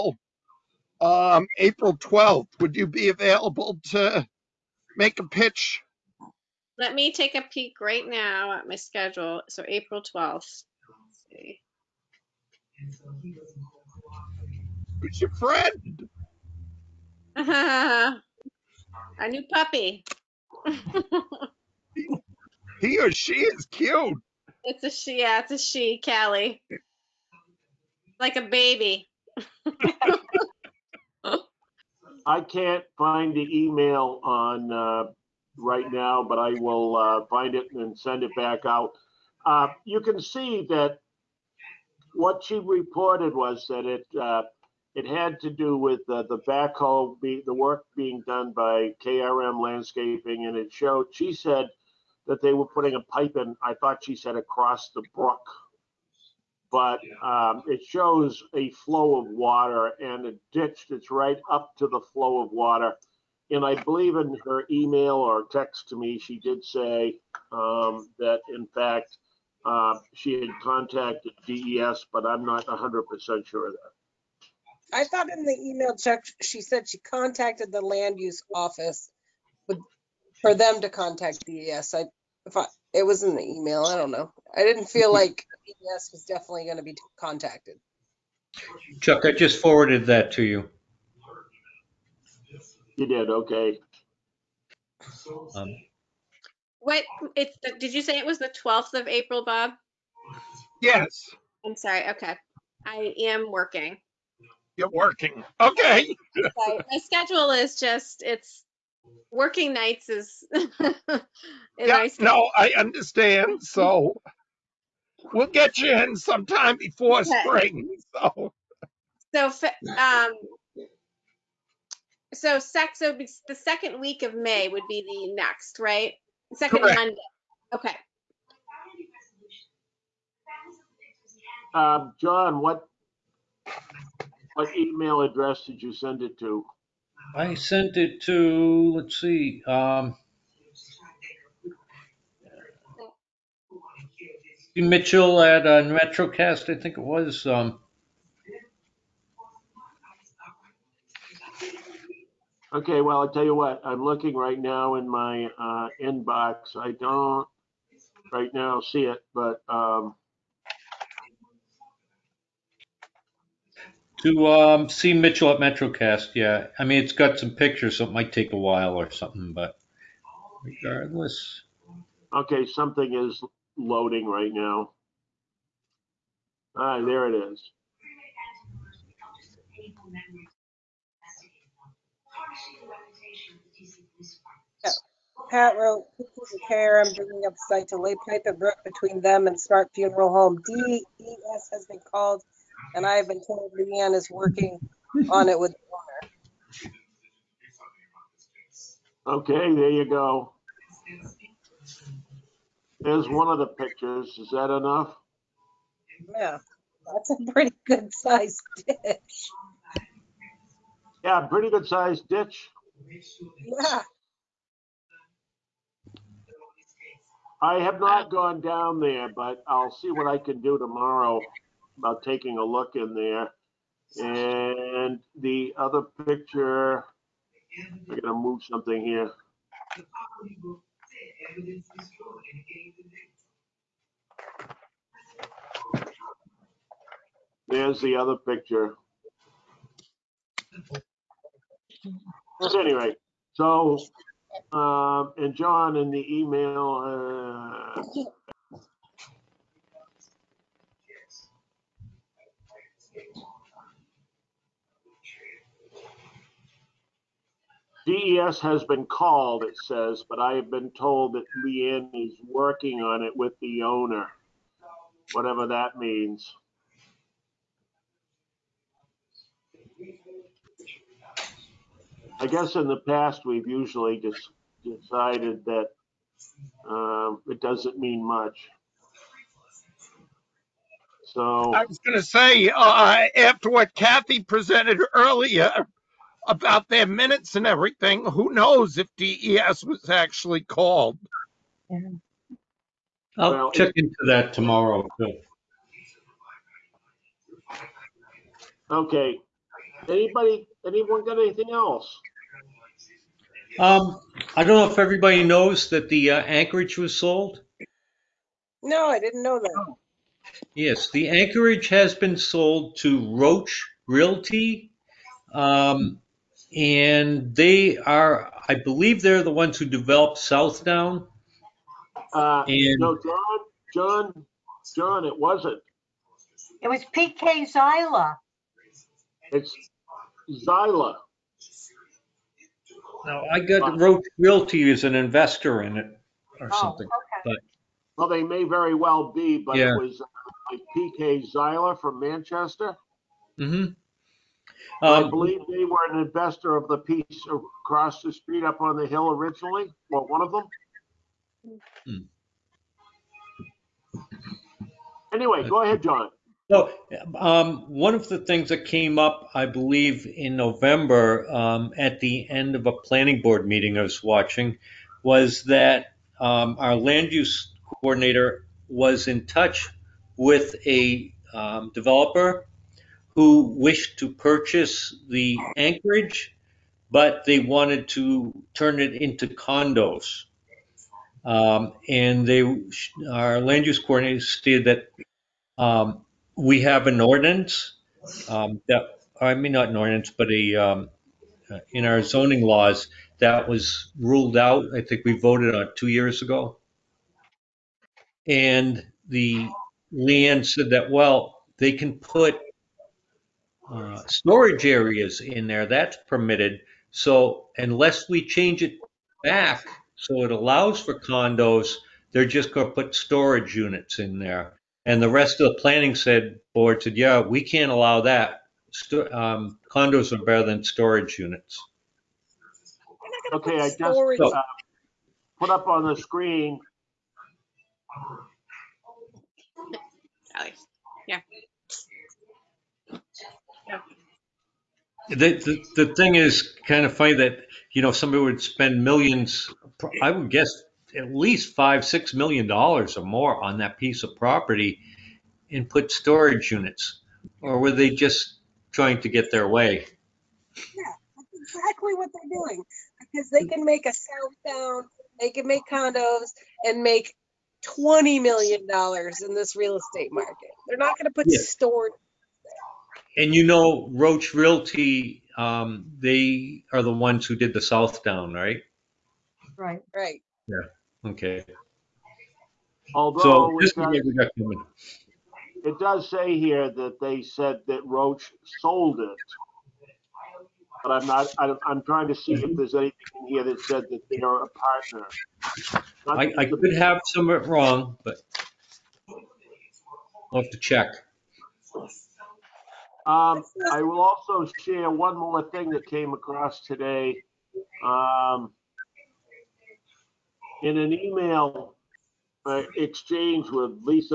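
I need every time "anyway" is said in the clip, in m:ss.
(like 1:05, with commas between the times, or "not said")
4:02, 5:55.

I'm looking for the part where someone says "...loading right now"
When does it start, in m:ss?
2:53.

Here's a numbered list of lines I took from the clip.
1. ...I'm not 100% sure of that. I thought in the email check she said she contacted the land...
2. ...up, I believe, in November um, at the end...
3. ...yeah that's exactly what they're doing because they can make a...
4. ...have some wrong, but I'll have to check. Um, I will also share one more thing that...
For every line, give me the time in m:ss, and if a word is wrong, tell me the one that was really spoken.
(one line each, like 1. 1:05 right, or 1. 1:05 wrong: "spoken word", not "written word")
1. 1:12 right
2. 5:59 right
3. 7:30 right
4. 8:06 right.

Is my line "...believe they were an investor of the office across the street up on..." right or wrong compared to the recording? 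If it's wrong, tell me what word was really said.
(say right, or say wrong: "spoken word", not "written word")
wrong: "piece", not "office".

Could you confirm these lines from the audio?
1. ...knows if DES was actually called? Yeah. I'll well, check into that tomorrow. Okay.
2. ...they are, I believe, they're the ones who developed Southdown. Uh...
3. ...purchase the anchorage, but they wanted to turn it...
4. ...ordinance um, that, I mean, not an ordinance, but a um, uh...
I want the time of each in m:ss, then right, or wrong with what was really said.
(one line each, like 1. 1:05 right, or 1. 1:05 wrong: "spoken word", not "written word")
1. 4:48 right
2. 5:17 right
3. 6:14 right
4. 6:27 right.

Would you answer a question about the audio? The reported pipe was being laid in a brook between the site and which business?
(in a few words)
Smart Funeral Home.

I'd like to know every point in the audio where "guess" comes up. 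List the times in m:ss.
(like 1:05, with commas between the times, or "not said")
4:32, 7:20.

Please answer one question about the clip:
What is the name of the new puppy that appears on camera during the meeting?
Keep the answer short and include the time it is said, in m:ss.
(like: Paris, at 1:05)
Callie, at 0:26.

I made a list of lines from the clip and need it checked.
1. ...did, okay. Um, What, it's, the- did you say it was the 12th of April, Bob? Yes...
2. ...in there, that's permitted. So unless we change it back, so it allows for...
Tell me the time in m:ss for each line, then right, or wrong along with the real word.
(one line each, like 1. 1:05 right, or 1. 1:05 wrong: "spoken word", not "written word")
1. 1:33 right
2. 6:45 right.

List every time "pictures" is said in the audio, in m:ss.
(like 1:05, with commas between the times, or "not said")
2:47, 3:23, 3:46, 3:58.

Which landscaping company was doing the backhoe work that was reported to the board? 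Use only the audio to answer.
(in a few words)
KRM Landscaping.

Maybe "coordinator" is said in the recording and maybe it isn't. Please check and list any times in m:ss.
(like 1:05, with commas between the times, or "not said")
6:08, 6:23.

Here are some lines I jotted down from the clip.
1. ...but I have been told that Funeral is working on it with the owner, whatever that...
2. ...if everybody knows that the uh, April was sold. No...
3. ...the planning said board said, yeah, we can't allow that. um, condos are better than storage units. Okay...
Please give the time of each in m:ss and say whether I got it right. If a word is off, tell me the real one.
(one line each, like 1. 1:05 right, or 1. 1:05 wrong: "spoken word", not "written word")
1. 4:20 wrong: "Leanne", not "Funeral"
2. 5:04 wrong: "Anchorage", not "April"
3. 6:55 right.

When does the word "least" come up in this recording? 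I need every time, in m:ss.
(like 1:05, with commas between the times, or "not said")
7:21.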